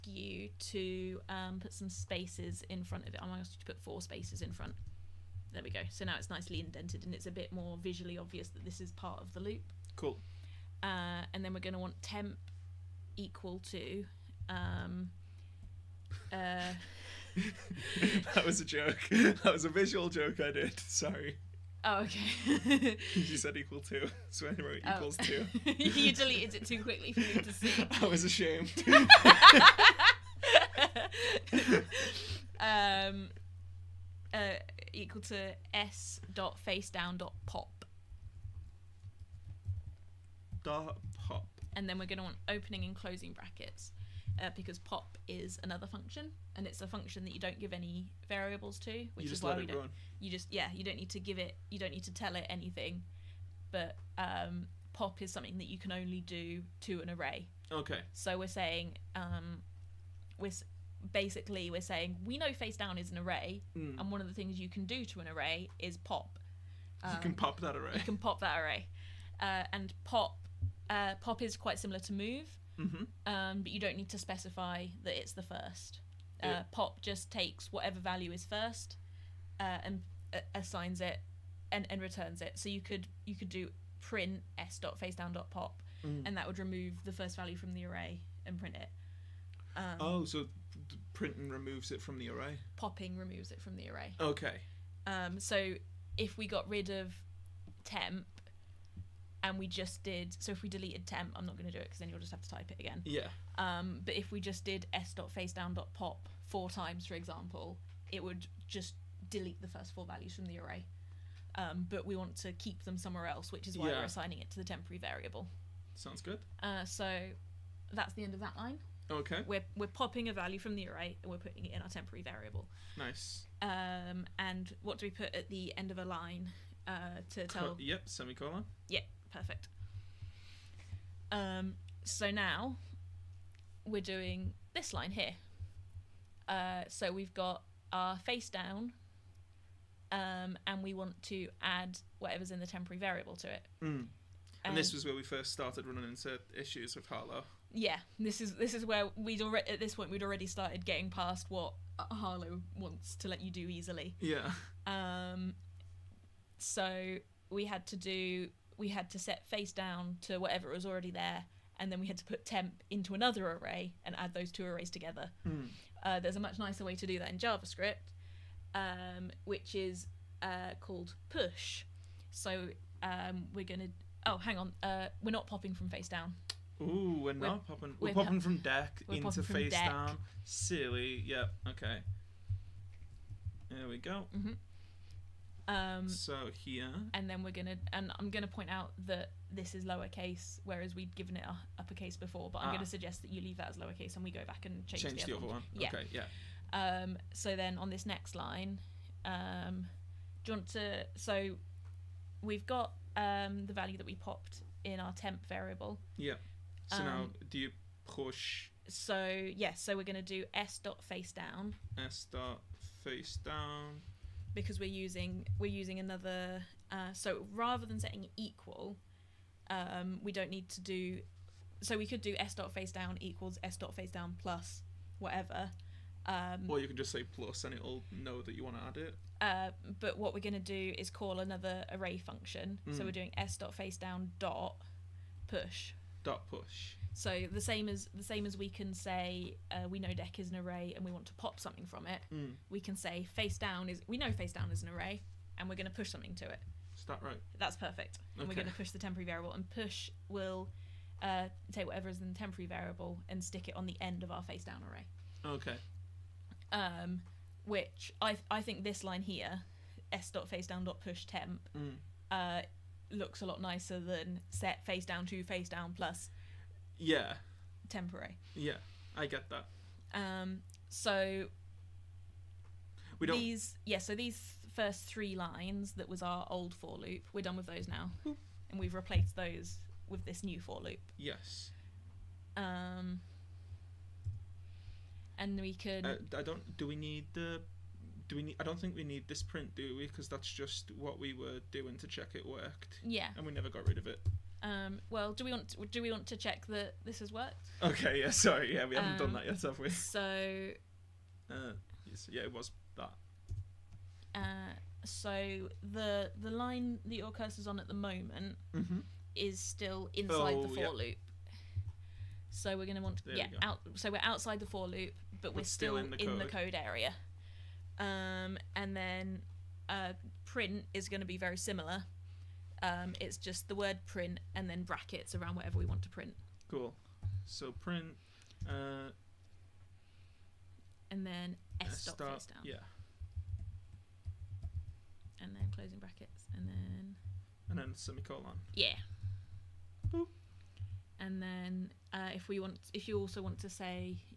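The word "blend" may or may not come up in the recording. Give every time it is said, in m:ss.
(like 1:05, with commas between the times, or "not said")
not said.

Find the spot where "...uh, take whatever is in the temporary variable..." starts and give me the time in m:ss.
4:11.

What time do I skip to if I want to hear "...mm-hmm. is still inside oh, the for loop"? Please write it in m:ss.
5:08.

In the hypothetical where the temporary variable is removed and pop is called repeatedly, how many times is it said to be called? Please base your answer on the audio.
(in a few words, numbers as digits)
4.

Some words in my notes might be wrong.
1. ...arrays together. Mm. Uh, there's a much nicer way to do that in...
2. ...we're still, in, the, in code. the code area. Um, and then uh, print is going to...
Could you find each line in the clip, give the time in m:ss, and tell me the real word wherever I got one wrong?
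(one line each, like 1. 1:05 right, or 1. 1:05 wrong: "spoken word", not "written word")
1. 2:44 right
2. 5:15 right.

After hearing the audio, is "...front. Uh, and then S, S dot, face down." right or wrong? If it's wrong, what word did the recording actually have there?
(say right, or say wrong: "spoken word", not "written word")
wrong: "print", not "front".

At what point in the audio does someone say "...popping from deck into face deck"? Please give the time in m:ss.
2:58.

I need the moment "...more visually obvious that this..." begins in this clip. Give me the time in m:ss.
0:07.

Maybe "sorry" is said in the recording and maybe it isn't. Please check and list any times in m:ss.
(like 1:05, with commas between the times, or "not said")
0:20, 4:58.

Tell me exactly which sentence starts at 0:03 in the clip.
I'm gonna ask you to put four spaces in front.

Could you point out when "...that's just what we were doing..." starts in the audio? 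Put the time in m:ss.
4:50.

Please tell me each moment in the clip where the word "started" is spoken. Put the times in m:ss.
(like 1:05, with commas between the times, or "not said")
2:25, 2:30.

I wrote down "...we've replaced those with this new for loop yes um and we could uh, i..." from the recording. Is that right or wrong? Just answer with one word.
right.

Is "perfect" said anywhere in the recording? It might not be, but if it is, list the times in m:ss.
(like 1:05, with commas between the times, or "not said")
2:09, 4:07.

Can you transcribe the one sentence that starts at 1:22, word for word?
So you could you could do print s dot face down dot pop, mm.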